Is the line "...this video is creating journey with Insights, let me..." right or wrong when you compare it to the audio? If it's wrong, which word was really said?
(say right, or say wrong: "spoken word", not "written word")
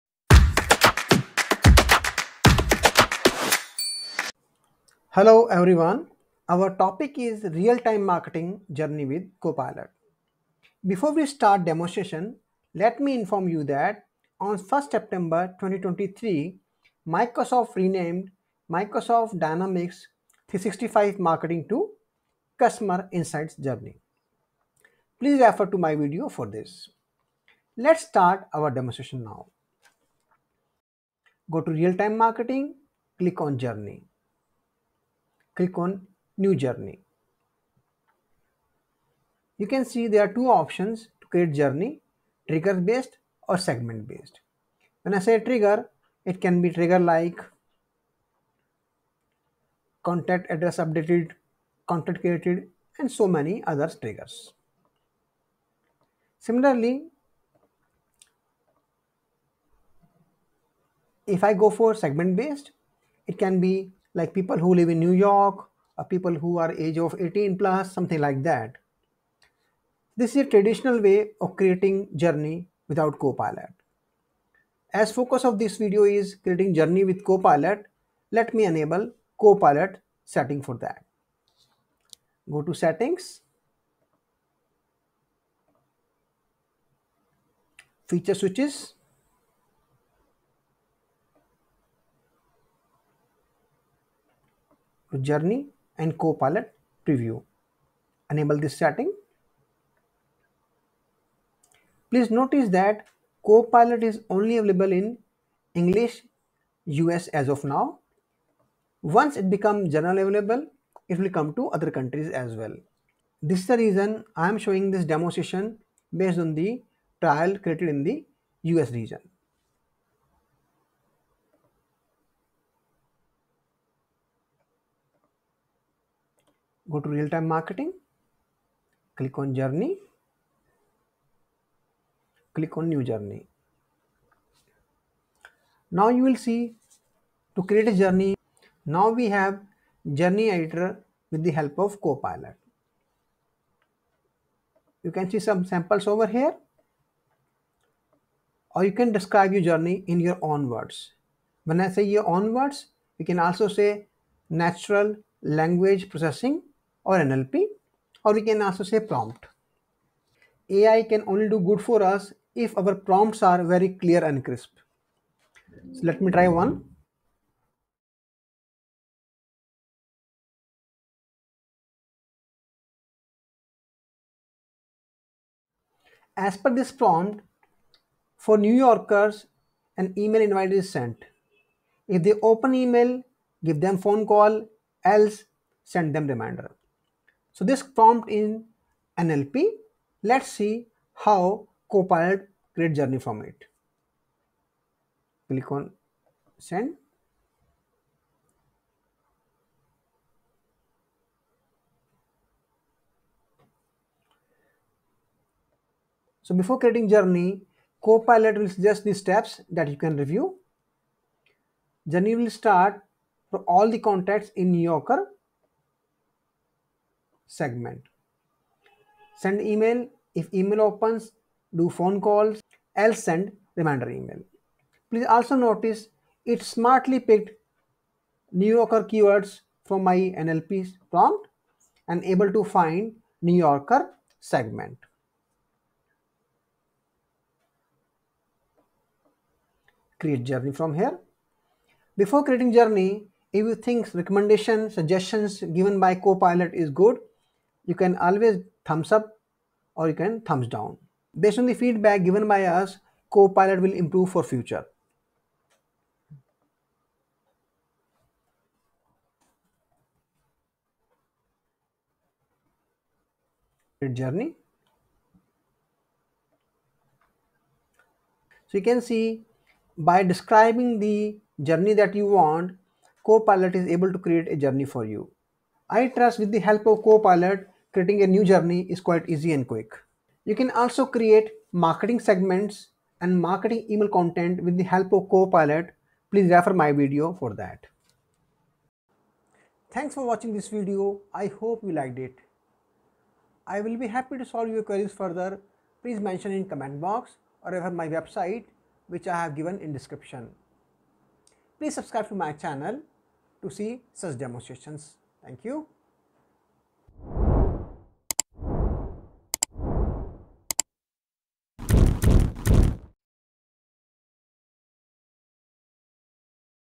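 wrong: "Copilot", not "Insights".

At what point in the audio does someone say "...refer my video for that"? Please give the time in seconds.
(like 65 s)
286 s.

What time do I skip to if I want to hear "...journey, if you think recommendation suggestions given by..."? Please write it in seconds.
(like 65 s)
242 s.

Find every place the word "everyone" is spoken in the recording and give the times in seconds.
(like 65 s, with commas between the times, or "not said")
5 s.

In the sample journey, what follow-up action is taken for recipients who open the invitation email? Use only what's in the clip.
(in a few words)
Phone call.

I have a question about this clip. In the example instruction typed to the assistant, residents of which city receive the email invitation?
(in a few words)
New York.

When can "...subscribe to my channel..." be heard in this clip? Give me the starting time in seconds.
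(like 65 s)
301 s.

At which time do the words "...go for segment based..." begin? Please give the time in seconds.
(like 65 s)
61 s.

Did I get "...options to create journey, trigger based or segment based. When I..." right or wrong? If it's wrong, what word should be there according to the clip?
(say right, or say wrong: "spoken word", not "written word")
right.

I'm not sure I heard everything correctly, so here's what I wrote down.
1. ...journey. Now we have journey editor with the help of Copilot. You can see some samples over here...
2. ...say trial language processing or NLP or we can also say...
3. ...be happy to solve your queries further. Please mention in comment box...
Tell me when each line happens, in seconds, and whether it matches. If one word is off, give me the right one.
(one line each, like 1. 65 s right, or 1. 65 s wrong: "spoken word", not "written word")
1. 138 s right
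2. 153 s wrong: "natural", not "trial"
3. 293 s right.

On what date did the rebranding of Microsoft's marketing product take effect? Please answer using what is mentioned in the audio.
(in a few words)
1 September 2023.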